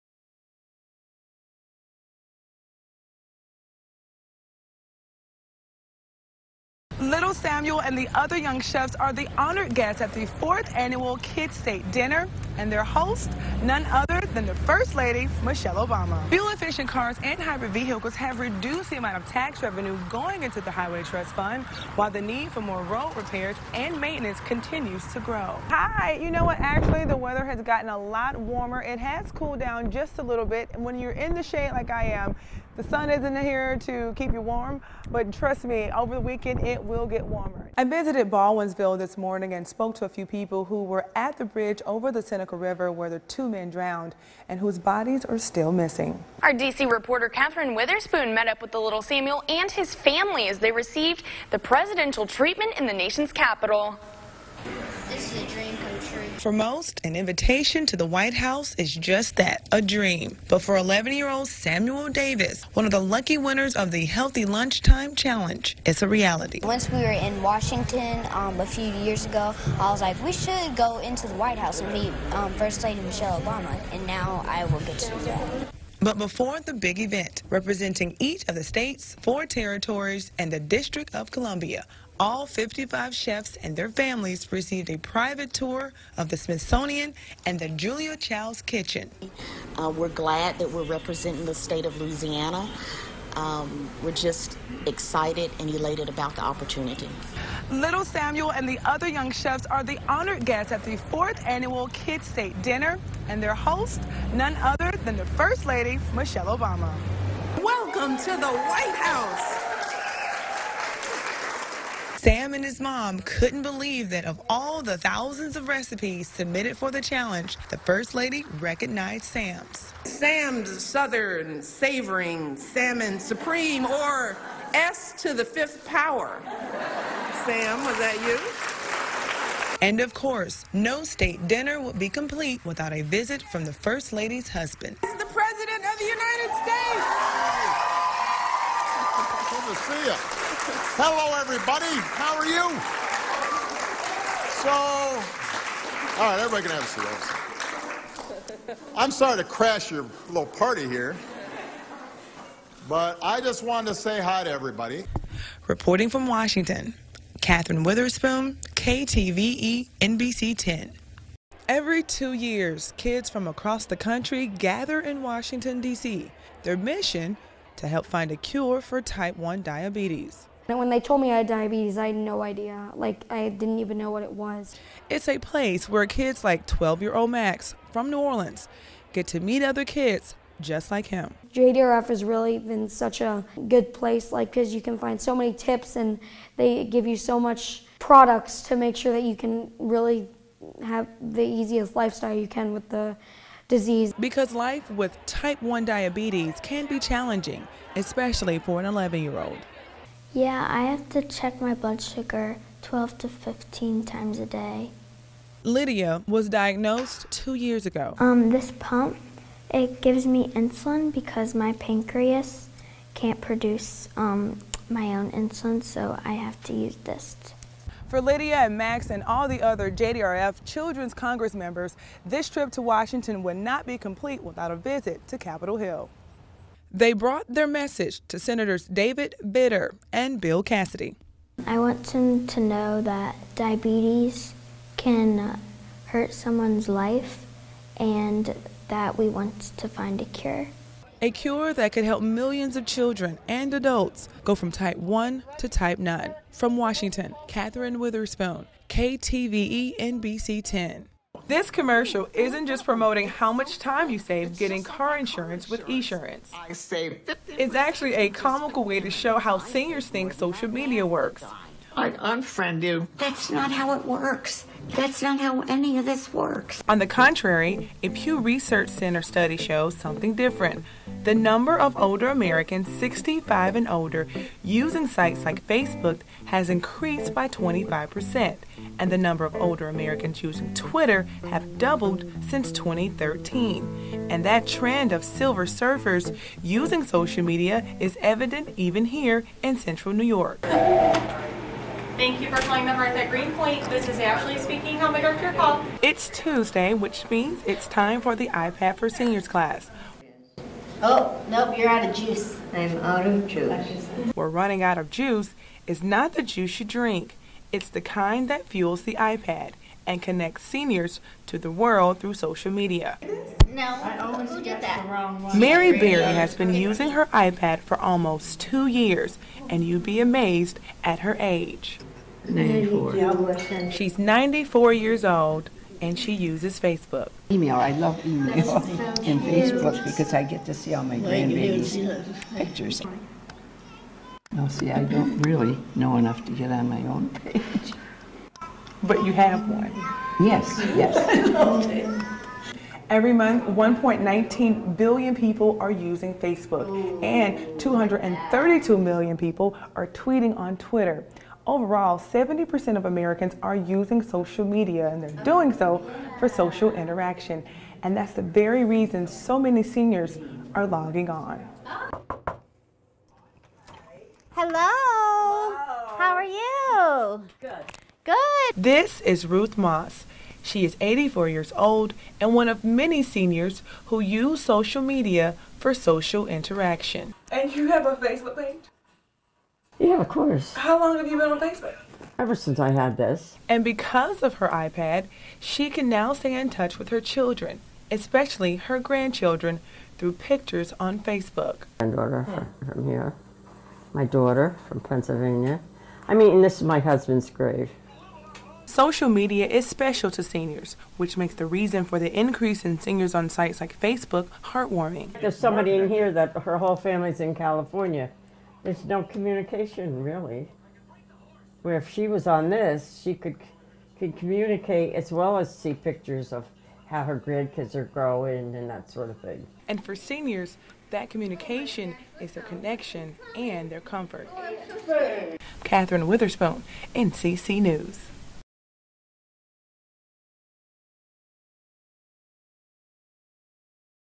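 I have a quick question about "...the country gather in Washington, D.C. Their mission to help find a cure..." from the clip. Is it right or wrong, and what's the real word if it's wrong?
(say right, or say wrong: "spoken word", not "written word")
right.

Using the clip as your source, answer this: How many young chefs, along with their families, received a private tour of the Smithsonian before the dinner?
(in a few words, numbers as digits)
55.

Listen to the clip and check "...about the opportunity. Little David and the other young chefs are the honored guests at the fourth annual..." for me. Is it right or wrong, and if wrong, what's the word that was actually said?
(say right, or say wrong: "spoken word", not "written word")
wrong: "Samuel", not "David".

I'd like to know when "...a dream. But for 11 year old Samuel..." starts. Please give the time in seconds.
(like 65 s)
59 s.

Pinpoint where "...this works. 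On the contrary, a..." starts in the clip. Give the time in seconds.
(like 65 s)
266 s.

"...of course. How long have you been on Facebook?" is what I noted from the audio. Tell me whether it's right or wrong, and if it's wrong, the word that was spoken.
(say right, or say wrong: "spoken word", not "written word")
right.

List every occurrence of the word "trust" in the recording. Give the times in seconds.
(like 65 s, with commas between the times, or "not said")
21 s, 35 s.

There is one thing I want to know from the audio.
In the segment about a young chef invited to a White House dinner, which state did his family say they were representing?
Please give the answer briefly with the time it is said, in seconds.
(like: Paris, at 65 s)
Louisiana, at 92 s.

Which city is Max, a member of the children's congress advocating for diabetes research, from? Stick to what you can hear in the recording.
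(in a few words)
New Orleans.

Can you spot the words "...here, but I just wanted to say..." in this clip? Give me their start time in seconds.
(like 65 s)
150 s.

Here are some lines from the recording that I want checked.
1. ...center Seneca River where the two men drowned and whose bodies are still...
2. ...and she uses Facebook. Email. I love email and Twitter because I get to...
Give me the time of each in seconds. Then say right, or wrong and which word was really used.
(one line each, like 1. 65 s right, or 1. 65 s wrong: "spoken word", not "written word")
1. 42 s right
2. 326 s wrong: "Facebook", not "Twitter".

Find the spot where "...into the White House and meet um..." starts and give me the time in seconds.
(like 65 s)
70 s.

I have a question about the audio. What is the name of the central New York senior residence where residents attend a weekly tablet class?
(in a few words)
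the Hearth at Greenpoint.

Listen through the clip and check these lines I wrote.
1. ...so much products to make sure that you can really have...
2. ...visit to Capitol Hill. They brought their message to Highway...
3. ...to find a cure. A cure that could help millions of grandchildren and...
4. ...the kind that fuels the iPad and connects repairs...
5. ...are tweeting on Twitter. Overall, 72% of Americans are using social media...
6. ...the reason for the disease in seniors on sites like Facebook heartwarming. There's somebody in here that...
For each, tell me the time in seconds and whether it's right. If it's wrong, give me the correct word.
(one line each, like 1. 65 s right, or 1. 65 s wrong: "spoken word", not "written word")
1. 187 s right
2. 224 s wrong: "Senators", not "Highway"
3. 239 s wrong: "children", not "grandchildren"
4. 307 s wrong: "seniors", not "repairs"
5. 349 s wrong: "70", not "72"
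6. 401 s wrong: "increase", not "disease".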